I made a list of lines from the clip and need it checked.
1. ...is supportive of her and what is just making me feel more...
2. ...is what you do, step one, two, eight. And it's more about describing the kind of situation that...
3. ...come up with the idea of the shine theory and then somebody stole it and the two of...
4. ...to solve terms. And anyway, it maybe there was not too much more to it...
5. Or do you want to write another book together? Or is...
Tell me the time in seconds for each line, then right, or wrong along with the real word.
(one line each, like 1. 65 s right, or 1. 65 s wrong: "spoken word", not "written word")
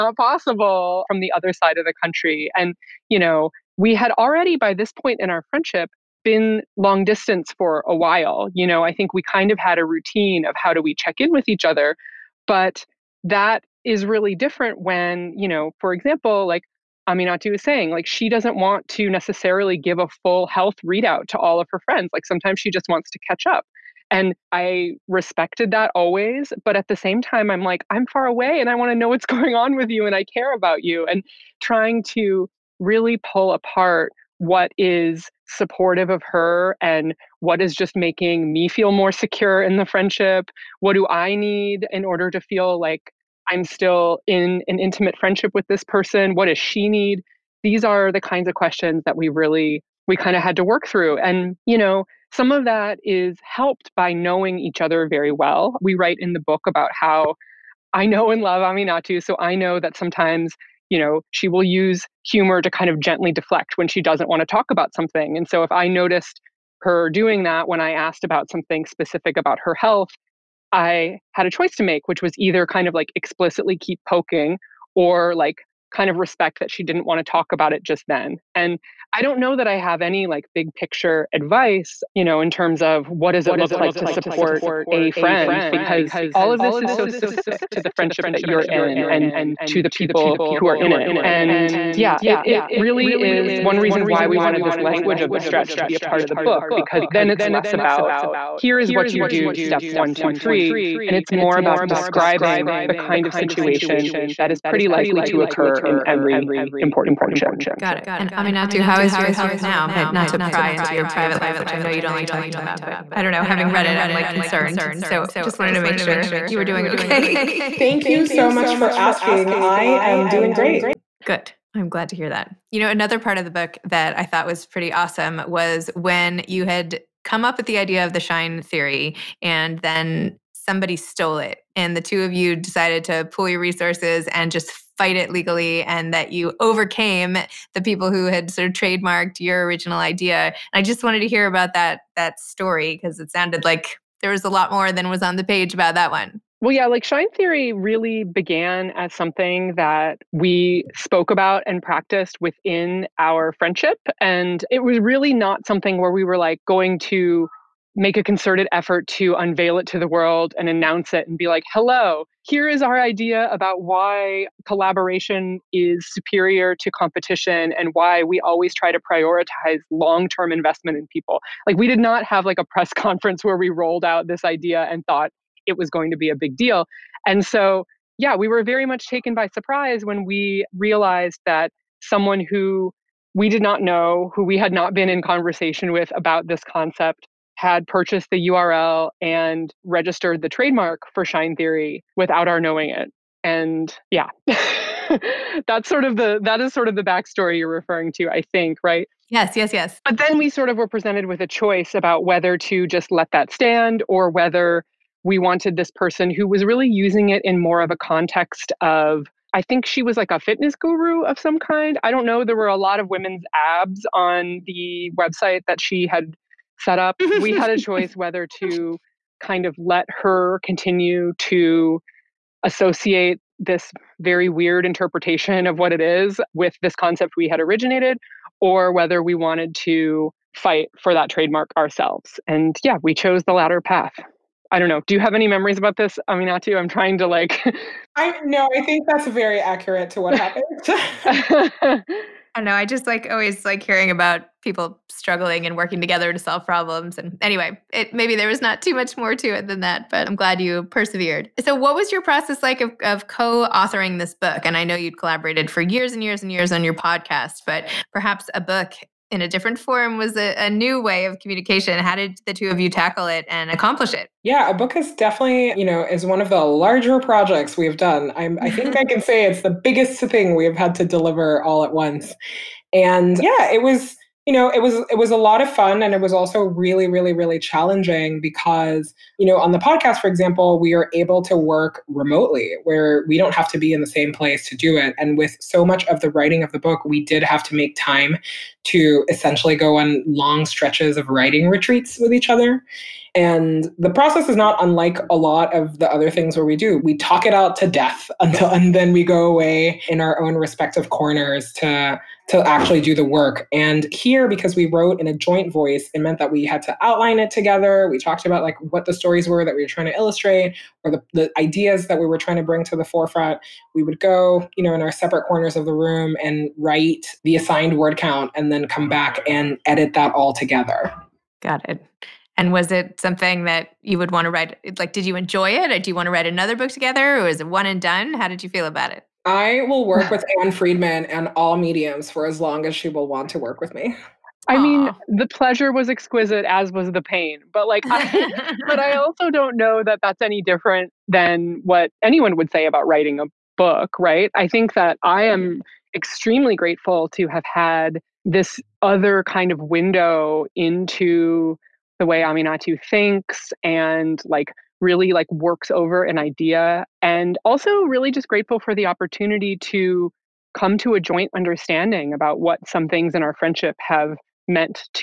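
1. 34 s right
2. 98 s wrong: "three", not "eight"
3. 127 s right
4. 246 s wrong: "problems", not "terms"
5. 325 s right.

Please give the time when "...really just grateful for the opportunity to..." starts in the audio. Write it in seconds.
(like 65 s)
358 s.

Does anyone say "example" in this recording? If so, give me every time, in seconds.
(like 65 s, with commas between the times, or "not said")
15 s, 280 s.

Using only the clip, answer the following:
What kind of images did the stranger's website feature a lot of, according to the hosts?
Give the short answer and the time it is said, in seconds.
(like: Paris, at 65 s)
women's abs, at 213 s.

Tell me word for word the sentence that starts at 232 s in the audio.
And yeah, we chose the latter path.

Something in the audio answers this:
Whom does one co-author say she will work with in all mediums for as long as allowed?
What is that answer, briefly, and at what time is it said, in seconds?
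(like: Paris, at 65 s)
Ann Friedman, at 330 s.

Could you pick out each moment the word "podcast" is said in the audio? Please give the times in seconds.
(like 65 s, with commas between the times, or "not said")
256 s, 279 s.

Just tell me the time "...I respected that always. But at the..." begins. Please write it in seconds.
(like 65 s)
24 s.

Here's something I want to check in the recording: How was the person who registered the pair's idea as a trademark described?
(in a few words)
fitness guru.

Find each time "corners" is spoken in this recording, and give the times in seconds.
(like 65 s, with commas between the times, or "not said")
301 s, 315 s.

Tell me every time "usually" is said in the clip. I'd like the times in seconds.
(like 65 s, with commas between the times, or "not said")
not said.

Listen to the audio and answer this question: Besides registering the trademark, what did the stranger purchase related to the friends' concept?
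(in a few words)
the URL.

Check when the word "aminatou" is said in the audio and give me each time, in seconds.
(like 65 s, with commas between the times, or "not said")
17 s, 58 s, 108 s, 236 s, 352 s.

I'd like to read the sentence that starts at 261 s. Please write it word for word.
How did the two of you tackle it and accomplish it?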